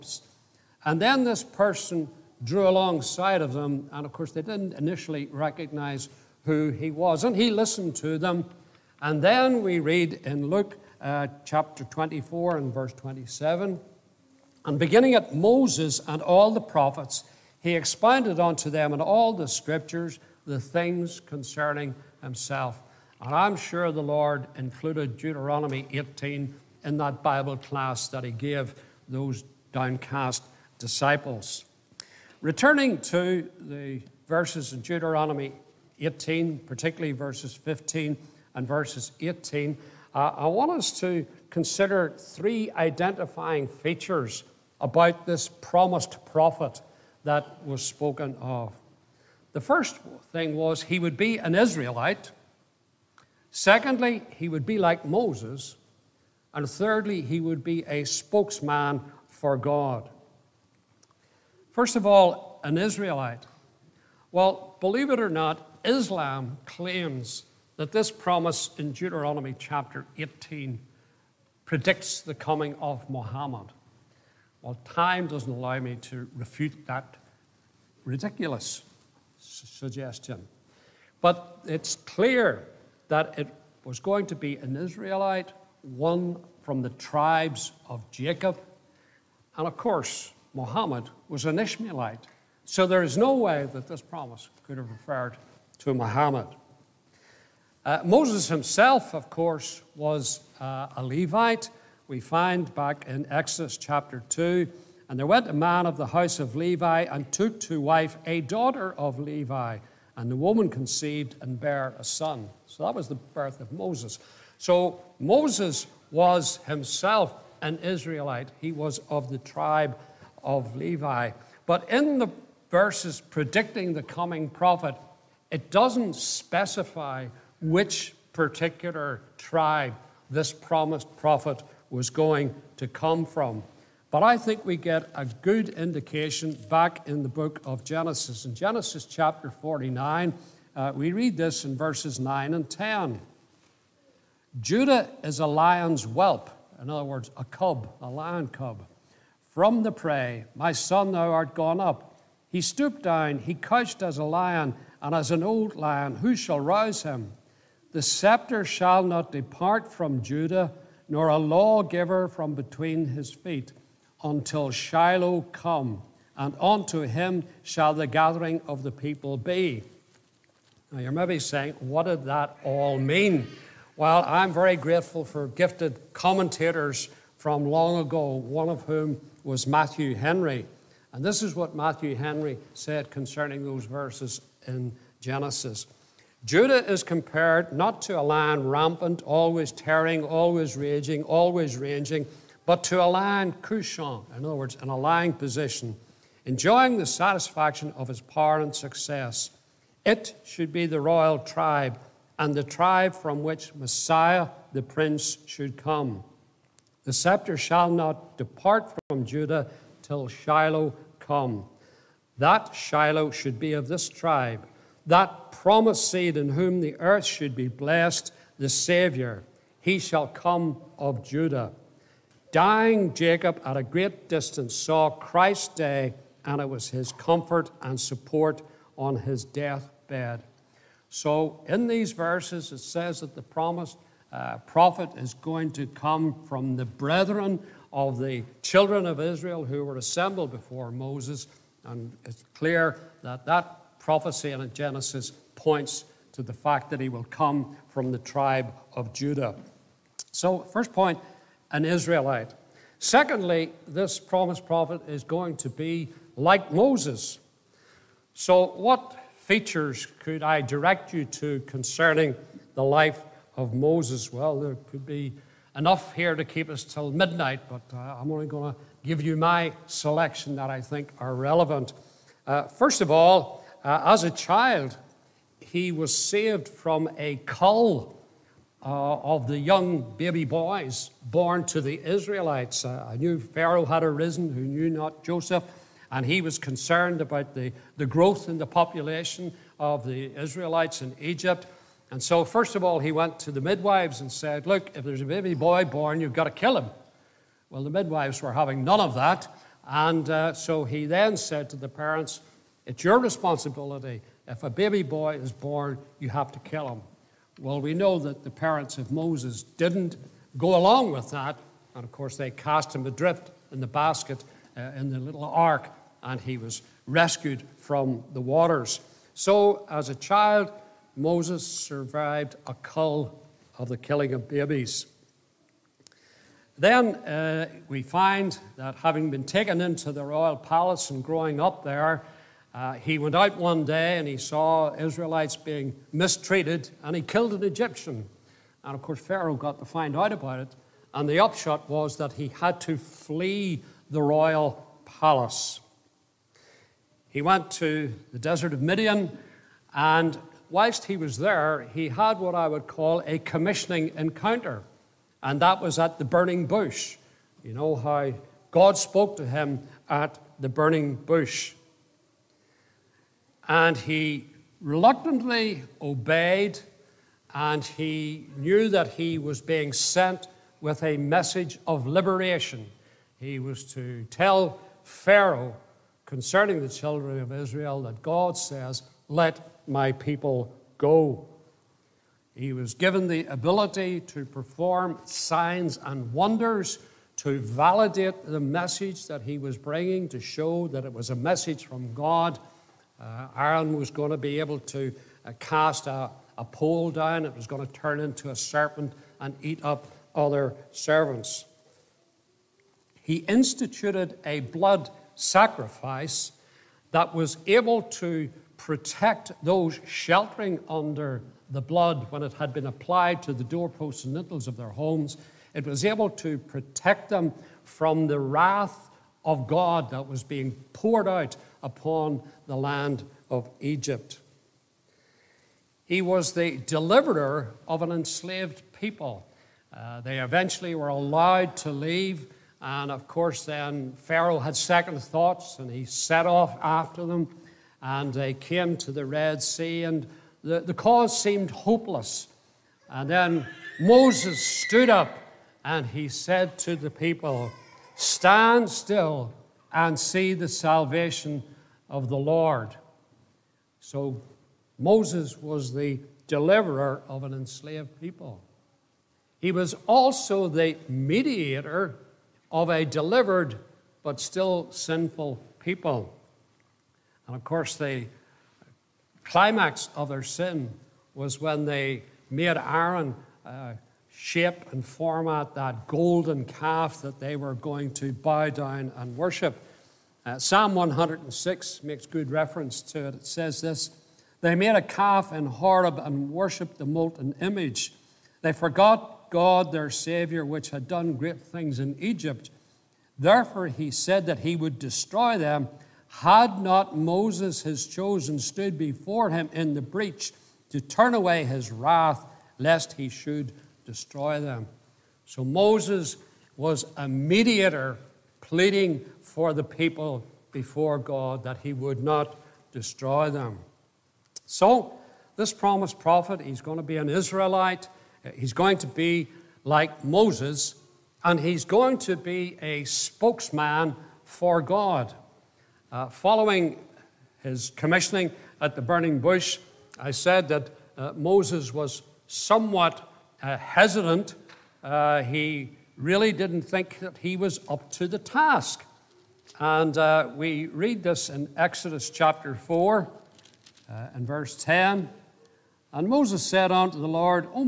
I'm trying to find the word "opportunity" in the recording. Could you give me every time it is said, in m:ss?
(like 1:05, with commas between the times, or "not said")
not said.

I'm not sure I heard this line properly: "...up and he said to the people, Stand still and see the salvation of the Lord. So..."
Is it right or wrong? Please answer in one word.
right.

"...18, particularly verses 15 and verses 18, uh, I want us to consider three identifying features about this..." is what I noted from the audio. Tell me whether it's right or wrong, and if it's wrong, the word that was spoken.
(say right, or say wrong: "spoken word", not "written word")
right.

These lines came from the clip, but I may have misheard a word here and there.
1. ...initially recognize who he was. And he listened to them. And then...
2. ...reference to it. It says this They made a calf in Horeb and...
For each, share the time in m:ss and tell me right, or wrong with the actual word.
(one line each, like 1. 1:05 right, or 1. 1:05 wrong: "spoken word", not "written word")
1. 0:04 right
2. 8:02 right.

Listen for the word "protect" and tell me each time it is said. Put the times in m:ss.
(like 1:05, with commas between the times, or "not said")
6:48, 6:56.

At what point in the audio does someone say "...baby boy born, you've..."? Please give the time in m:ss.
4:55.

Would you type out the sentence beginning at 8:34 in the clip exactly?
So, this promised prophet, he's going to be an Israelite.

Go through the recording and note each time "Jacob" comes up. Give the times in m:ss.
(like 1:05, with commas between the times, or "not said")
1:28, 3:43.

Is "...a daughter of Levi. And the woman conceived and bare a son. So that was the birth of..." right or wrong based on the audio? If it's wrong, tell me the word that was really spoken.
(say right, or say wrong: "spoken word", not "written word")
right.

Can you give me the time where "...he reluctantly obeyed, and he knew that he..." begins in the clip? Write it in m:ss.
6:03.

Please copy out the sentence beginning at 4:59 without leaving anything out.
And uh, so he then said to the parents, it's your responsibility.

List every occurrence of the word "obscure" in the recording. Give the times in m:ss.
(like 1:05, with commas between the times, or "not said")
not said.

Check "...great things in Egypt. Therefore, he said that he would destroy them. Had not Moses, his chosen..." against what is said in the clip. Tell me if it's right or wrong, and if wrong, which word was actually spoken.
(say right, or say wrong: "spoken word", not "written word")
right.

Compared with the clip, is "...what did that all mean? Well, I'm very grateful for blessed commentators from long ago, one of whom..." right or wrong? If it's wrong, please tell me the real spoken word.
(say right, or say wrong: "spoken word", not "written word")
wrong: "gifted", not "blessed".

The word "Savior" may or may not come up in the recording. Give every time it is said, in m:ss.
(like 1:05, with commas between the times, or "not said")
3:38, 8:10.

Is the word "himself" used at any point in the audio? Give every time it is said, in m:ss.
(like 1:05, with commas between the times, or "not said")
0:22, 1:38, 1:56.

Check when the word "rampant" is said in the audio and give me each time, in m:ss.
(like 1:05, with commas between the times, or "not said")
3:08.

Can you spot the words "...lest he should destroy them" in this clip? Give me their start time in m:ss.
8:22.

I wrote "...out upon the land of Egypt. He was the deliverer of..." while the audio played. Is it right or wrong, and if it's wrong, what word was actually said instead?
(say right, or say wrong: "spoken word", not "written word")
right.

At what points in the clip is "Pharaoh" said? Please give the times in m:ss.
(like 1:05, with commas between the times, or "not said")
4:43, 5:39, 6:15, 7:14.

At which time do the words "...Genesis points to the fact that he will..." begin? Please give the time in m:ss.
4:04.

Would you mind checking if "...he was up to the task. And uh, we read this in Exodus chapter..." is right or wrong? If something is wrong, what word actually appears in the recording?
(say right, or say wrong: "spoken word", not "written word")
right.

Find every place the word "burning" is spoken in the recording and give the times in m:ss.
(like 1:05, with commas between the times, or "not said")
5:56, 6:00, 8:49.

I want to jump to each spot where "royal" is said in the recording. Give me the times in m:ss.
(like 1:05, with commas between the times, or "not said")
3:21, 5:30, 5:44.